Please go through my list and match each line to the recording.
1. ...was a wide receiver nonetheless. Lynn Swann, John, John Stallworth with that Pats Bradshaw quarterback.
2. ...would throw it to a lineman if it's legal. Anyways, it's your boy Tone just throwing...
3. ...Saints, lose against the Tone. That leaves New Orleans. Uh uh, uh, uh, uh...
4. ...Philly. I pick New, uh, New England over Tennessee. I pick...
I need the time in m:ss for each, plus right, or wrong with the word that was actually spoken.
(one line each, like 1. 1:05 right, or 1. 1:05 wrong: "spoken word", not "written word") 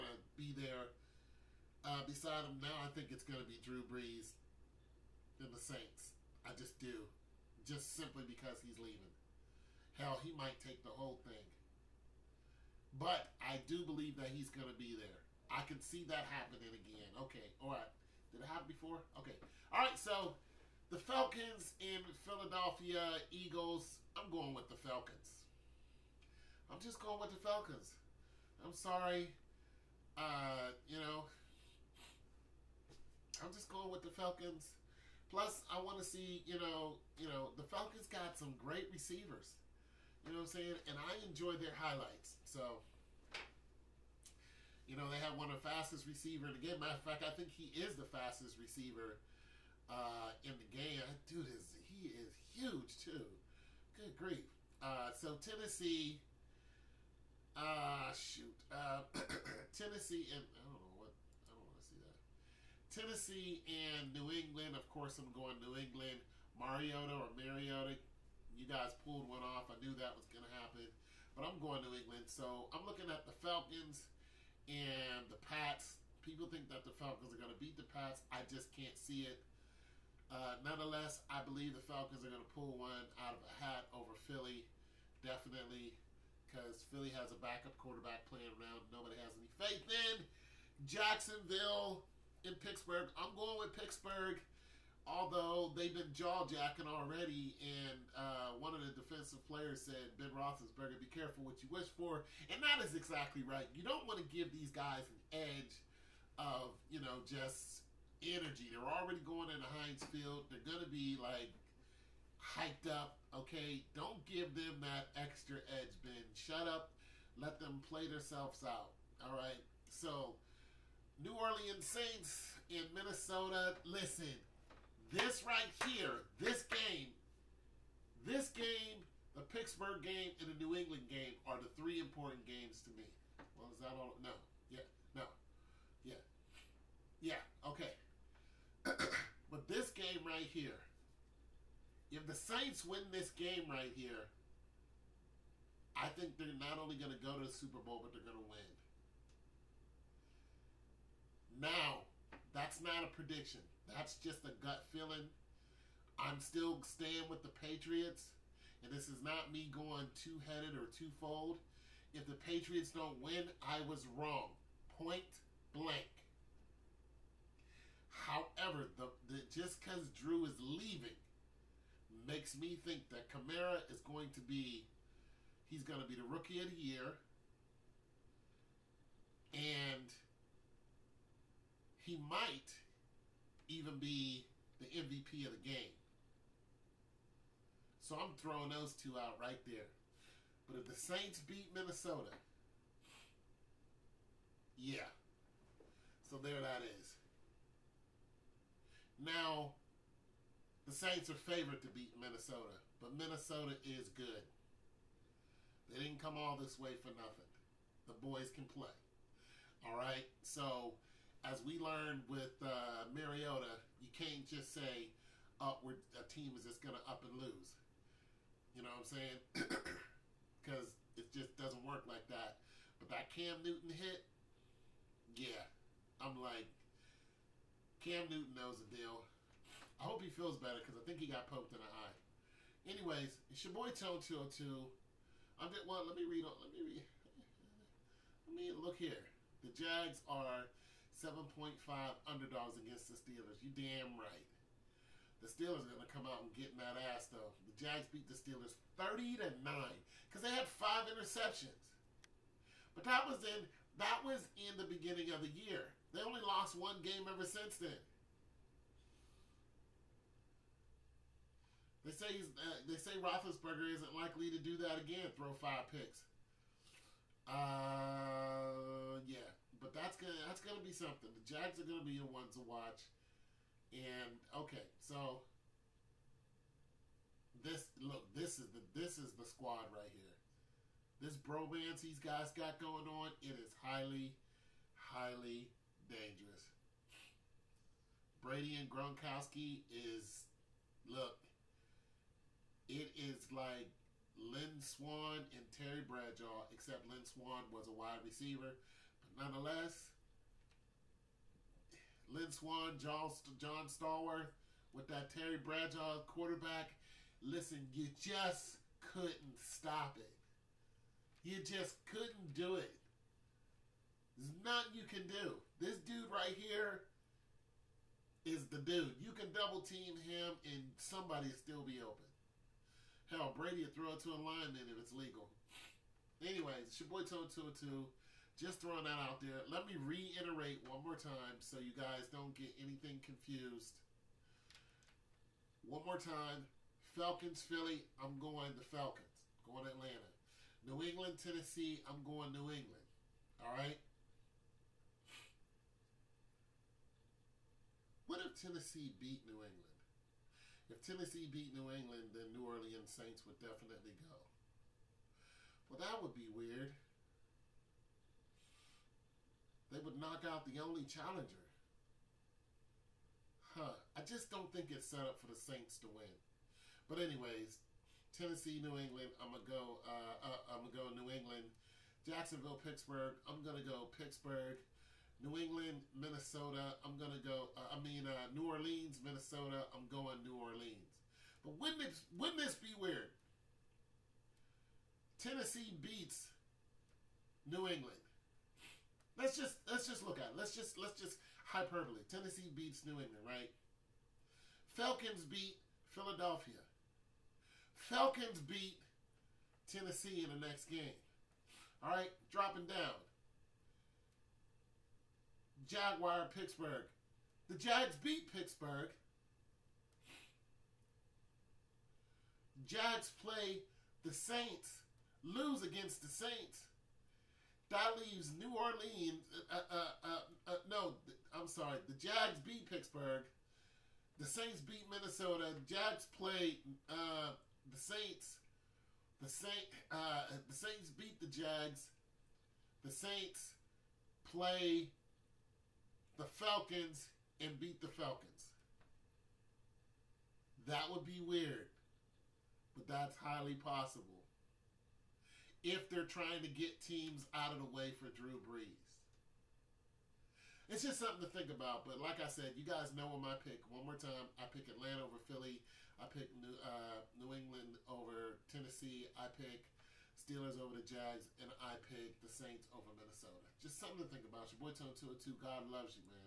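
1. 4:57 wrong: "Terry", not "Pats"
2. 5:23 right
3. 6:54 wrong: "Saints", not "Tone"
4. 7:35 right.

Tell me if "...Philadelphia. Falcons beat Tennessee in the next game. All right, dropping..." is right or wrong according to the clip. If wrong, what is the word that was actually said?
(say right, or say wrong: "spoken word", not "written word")
right.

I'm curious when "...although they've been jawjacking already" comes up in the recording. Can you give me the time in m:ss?
1:35.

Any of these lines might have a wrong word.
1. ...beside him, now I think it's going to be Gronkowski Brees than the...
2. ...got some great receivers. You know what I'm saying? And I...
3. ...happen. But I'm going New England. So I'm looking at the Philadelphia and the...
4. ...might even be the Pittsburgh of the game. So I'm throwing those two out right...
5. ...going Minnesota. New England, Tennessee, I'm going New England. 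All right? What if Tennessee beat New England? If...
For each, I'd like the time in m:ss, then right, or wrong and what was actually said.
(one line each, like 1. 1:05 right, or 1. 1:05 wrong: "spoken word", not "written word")
1. 0:02 wrong: "Drew", not "Gronkowski"
2. 0:38 right
3. 1:10 wrong: "Falcons", not "Philadelphia"
4. 3:02 wrong: "MVP", not "Pittsburgh"
5. 5:39 wrong: "Atlanta", not "Minnesota".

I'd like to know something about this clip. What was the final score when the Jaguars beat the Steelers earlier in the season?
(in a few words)
30 to 9.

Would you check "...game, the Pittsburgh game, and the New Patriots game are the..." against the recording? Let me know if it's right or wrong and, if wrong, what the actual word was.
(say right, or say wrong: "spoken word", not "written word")
wrong: "England", not "Patriots".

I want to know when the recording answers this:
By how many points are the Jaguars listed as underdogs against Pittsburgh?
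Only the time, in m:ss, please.
4:01.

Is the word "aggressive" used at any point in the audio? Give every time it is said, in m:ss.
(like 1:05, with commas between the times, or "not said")
not said.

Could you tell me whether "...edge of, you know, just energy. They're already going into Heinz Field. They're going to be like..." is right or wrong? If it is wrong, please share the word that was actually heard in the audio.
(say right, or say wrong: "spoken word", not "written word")
right.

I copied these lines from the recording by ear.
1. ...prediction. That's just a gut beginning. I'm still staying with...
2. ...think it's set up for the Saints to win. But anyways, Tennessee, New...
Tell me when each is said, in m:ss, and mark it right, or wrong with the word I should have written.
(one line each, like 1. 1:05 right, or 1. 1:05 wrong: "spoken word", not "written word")
1. 2:33 wrong: "feeling", not "beginning"
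2. 6:04 right.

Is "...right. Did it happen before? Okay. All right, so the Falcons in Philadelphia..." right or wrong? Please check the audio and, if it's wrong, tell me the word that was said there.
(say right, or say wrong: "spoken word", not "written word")
right.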